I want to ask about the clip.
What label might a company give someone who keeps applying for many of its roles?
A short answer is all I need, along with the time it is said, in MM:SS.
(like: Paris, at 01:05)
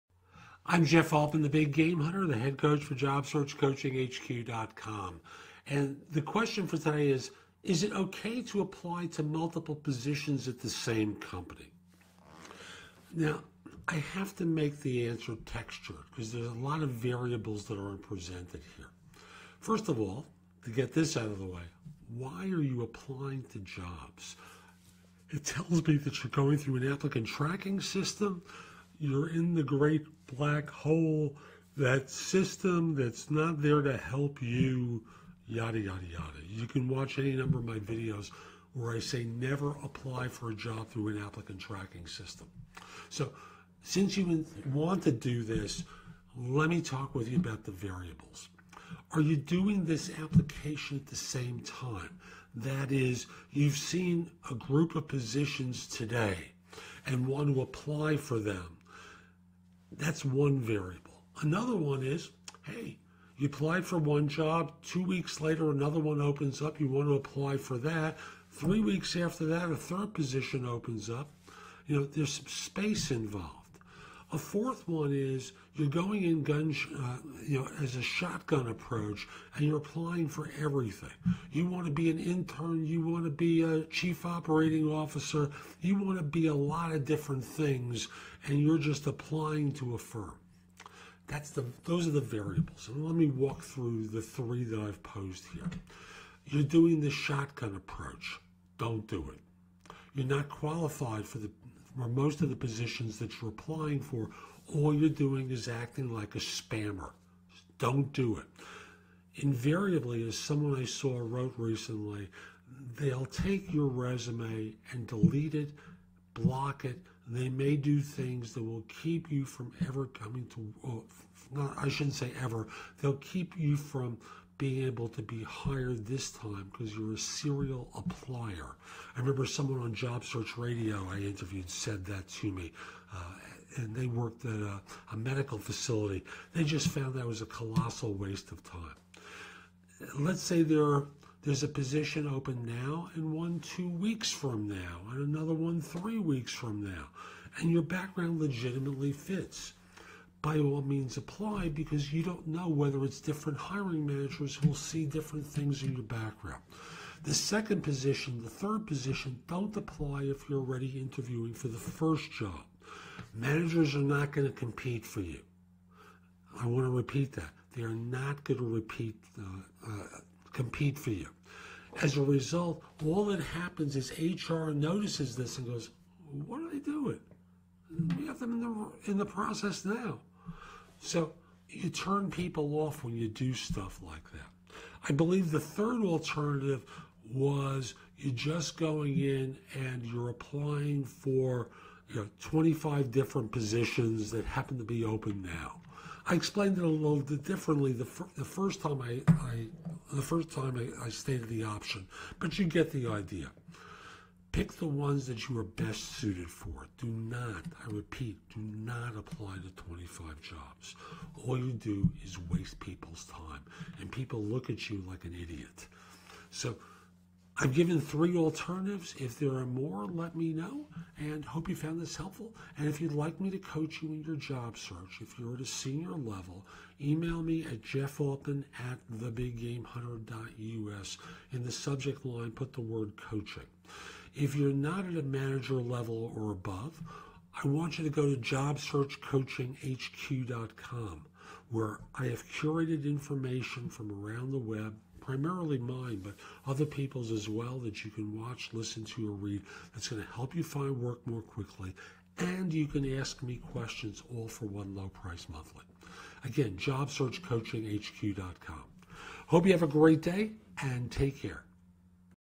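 serial applier, at 02:07.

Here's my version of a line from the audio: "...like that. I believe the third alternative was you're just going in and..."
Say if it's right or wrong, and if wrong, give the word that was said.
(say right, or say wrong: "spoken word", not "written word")
right.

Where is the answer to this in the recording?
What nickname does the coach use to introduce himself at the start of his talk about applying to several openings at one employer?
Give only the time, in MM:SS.
00:01.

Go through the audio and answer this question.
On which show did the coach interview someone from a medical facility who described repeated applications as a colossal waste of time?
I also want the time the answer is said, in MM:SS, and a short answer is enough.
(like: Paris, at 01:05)
Job Search Radio, at 02:09.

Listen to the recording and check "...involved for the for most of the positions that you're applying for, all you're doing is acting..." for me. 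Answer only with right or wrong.
wrong.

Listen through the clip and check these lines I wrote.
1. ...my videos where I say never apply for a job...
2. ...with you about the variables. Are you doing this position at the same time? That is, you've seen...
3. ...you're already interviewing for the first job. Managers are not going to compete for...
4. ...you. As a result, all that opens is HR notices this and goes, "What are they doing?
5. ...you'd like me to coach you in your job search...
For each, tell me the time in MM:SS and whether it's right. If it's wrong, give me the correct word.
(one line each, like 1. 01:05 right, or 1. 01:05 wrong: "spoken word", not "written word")
1. 00:37 right
2. 00:47 wrong: "application", not "position"
3. 02:40 right
4. 02:51 wrong: "happens", not "opens"
5. 03:42 right.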